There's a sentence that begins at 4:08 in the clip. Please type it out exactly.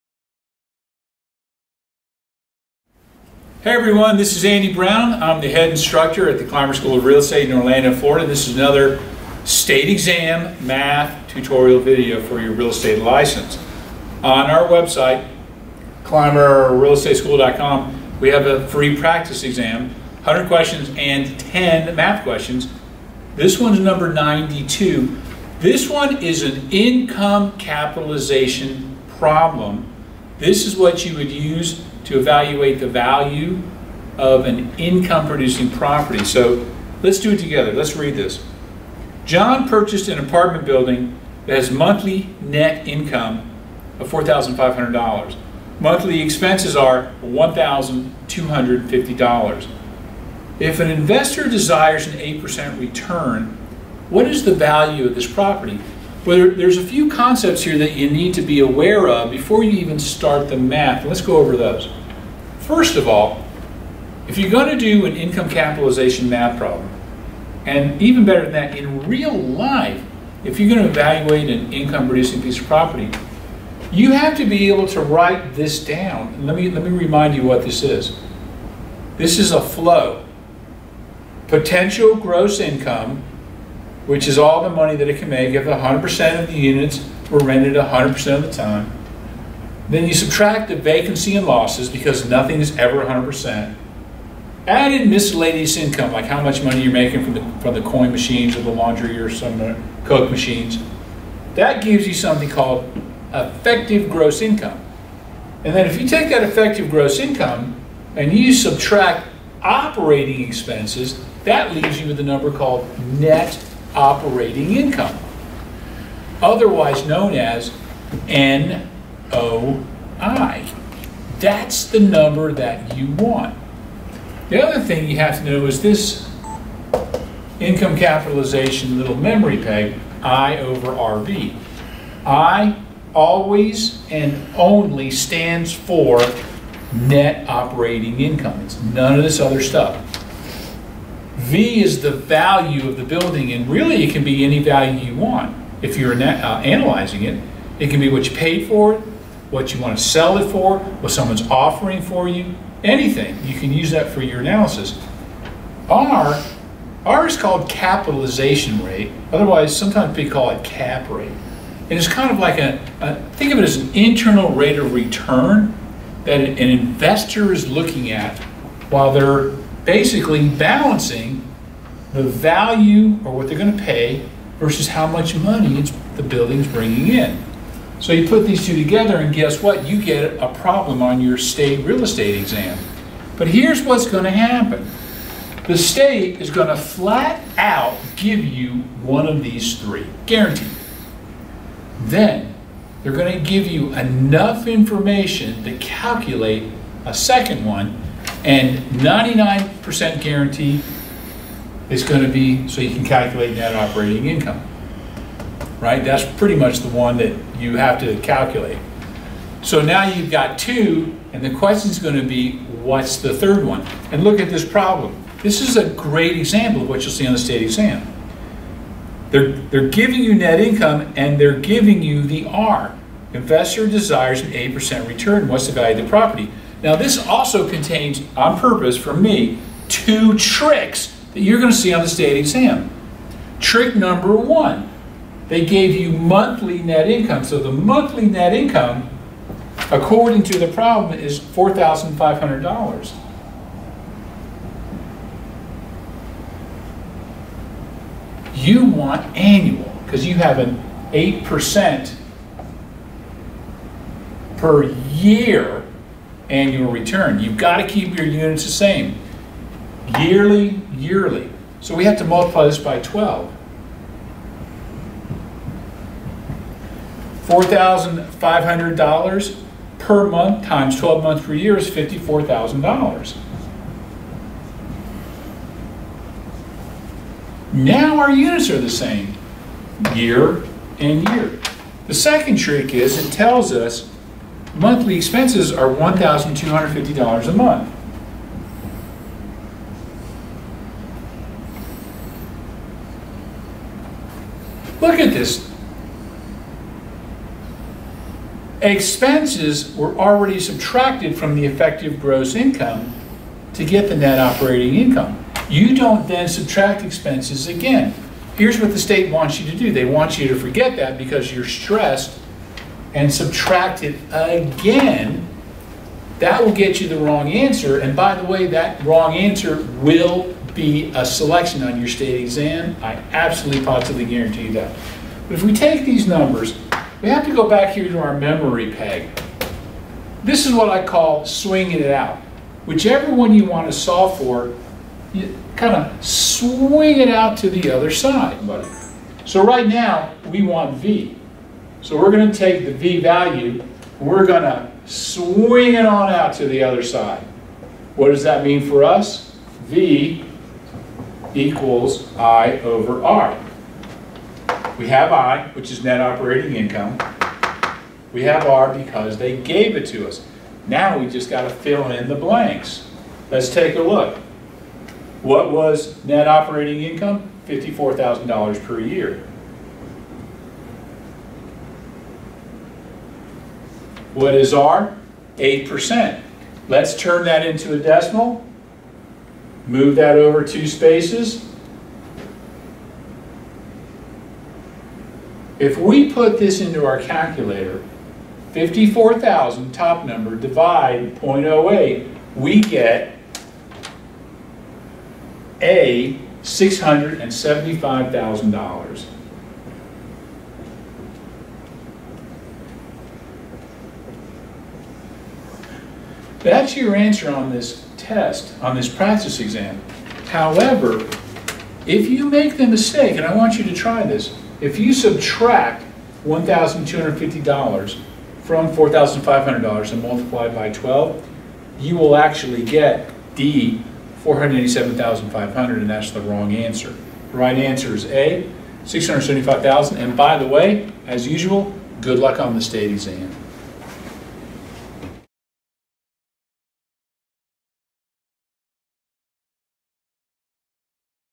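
You want annual because you have an 8% per year annual return.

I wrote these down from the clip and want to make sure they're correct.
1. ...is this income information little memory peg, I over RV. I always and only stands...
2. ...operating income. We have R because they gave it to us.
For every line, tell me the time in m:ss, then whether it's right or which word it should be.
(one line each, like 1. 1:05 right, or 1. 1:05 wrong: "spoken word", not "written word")
1. 2:05 wrong: "capitalization", not "information"
2. 5:56 right.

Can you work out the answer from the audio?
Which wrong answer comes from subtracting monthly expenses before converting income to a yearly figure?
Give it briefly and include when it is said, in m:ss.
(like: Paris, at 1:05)
487,500, at 7:04.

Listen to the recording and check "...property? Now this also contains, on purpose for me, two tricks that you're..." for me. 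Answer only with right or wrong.
right.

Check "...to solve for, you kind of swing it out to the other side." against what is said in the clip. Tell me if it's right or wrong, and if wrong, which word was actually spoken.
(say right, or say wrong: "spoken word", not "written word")
right.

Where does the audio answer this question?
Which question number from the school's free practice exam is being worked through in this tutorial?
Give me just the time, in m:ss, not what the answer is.
0:24.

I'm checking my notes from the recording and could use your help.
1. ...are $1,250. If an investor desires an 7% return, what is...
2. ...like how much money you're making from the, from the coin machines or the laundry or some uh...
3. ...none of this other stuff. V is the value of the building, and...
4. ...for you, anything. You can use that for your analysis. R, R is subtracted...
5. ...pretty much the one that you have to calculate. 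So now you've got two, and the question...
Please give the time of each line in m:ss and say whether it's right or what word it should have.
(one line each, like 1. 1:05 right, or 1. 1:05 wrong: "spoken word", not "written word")
1. 0:46 wrong: "8", not "7"
2. 1:36 right
3. 2:18 right
4. 2:32 wrong: "called", not "subtracted"
5. 3:26 right.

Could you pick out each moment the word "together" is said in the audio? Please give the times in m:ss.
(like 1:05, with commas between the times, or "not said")
0:37, 2:58.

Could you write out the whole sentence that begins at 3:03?
But here's what's going to happen the state is going to flat out give you one of these three, guaranteed.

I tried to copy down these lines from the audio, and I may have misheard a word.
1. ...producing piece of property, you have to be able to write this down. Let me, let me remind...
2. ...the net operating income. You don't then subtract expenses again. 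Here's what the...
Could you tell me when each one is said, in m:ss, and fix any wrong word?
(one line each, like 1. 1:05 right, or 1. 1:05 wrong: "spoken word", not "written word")
1. 1:12 right
2. 5:04 right.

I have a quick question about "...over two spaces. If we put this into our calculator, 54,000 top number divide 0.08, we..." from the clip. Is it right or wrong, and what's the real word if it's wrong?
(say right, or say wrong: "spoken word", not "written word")
right.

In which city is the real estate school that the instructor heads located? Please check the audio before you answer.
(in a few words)
Orlando.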